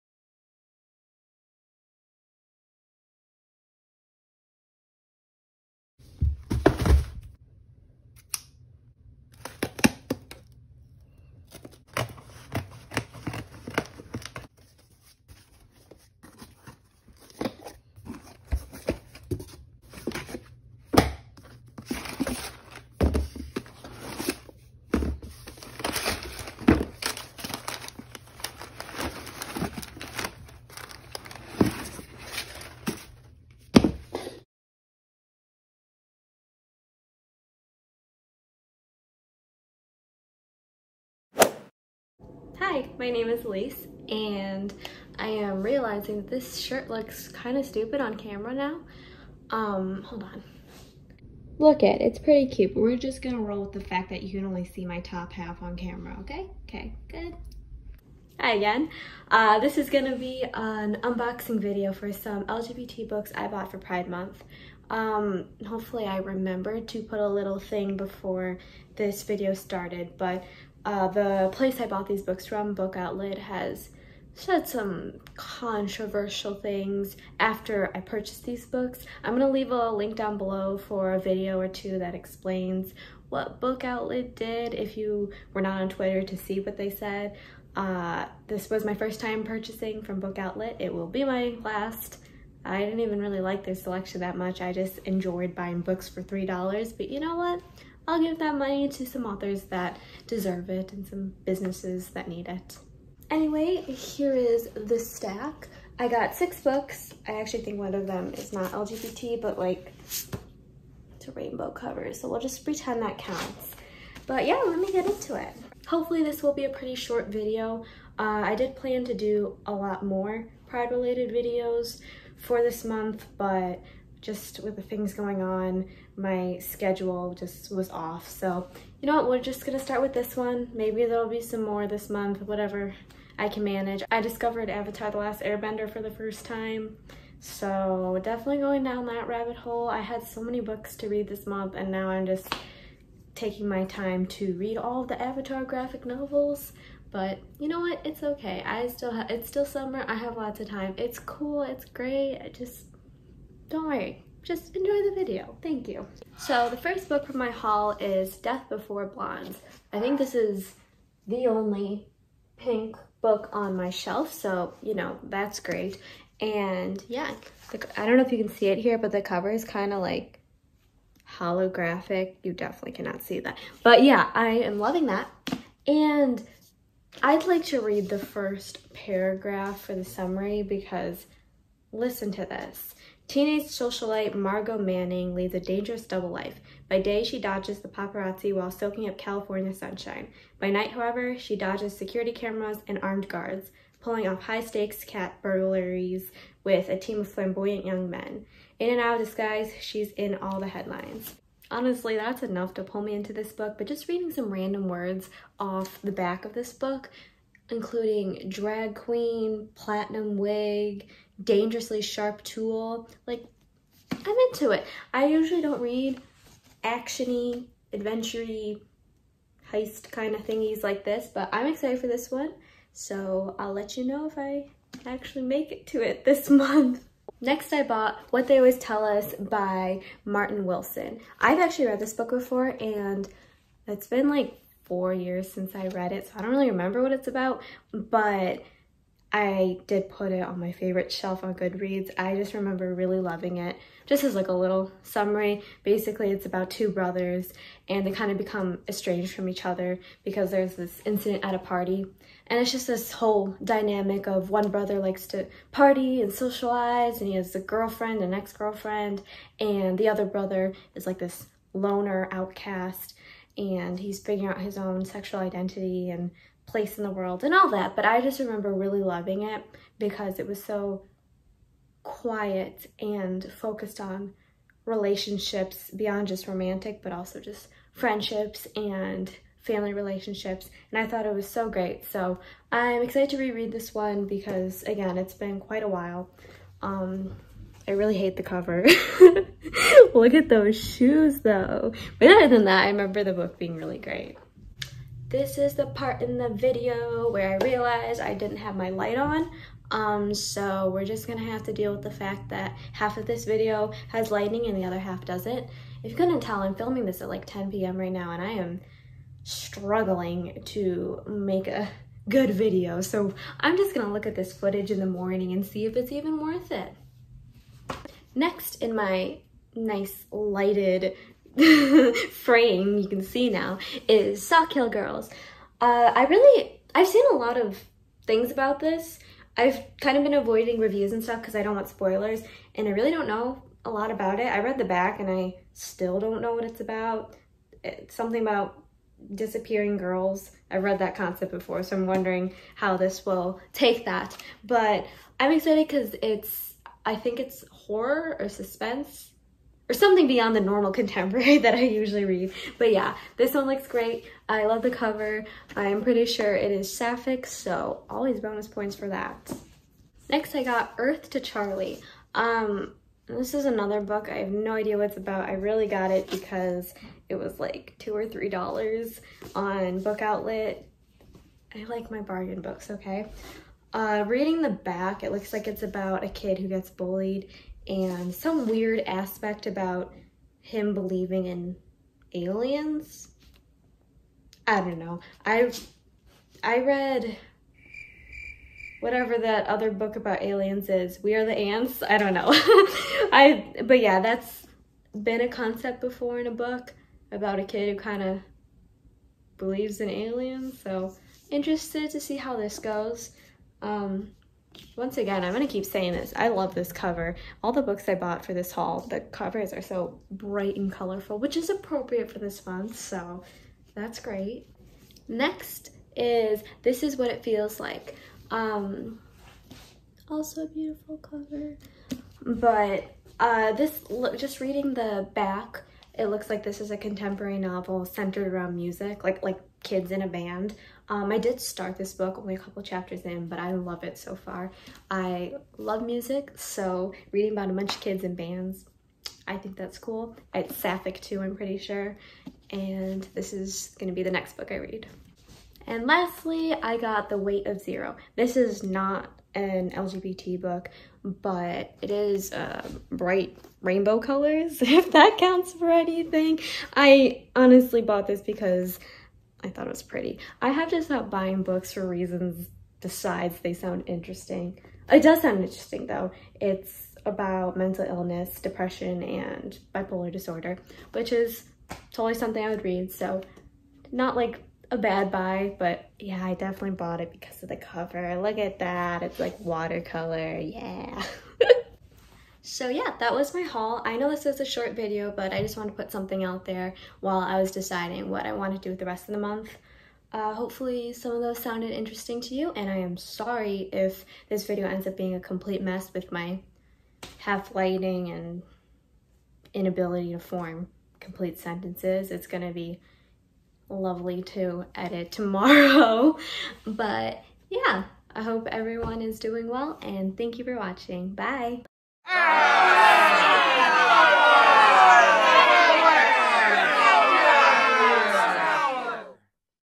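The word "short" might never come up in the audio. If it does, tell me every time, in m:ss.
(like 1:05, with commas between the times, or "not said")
1:56, 8:04.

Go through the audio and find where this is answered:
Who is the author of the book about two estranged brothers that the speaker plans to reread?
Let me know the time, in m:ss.
3:50.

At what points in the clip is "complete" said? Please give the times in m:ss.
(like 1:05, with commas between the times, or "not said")
8:15, 8:21.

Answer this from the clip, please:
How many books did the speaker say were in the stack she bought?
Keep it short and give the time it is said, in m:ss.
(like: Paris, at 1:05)
6, at 1:46.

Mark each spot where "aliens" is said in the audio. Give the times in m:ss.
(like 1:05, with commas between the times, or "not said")
6:22, 6:30, 6:40.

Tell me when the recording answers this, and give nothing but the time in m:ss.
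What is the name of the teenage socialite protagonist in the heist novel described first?
3:04.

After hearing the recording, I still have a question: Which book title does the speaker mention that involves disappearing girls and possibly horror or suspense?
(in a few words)
Sawkill Girls.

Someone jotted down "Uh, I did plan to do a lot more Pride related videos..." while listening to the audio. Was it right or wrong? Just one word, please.
right.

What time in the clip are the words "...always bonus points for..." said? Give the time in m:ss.
5:58.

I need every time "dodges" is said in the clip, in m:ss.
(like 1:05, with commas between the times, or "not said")
3:07, 3:11.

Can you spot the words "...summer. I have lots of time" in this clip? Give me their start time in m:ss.
2:29.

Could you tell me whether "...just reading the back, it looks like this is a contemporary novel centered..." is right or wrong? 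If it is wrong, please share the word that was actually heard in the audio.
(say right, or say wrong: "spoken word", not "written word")
right.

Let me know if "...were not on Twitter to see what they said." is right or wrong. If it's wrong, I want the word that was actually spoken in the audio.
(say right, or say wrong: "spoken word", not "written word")
right.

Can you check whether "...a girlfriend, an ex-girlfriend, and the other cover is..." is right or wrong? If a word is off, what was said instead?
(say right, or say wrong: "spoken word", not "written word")
wrong: "brother", not "cover".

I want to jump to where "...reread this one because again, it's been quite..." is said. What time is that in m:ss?
4:43.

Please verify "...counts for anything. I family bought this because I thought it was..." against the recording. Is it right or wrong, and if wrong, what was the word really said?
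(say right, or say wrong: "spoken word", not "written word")
wrong: "honestly", not "family".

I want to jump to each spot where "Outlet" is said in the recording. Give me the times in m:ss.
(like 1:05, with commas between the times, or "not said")
1:12, 1:23, 1:30, 6:10.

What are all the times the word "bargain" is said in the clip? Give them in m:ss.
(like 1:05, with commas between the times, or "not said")
6:12.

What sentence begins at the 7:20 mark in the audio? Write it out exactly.
It's sapphic too, I'm pretty sure.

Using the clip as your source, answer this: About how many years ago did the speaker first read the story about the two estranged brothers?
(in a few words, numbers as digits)
4.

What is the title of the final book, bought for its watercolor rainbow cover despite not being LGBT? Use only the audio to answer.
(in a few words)
The Weight of Zero.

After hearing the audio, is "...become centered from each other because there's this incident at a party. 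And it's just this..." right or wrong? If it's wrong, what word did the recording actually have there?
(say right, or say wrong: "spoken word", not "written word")
wrong: "estranged", not "centered".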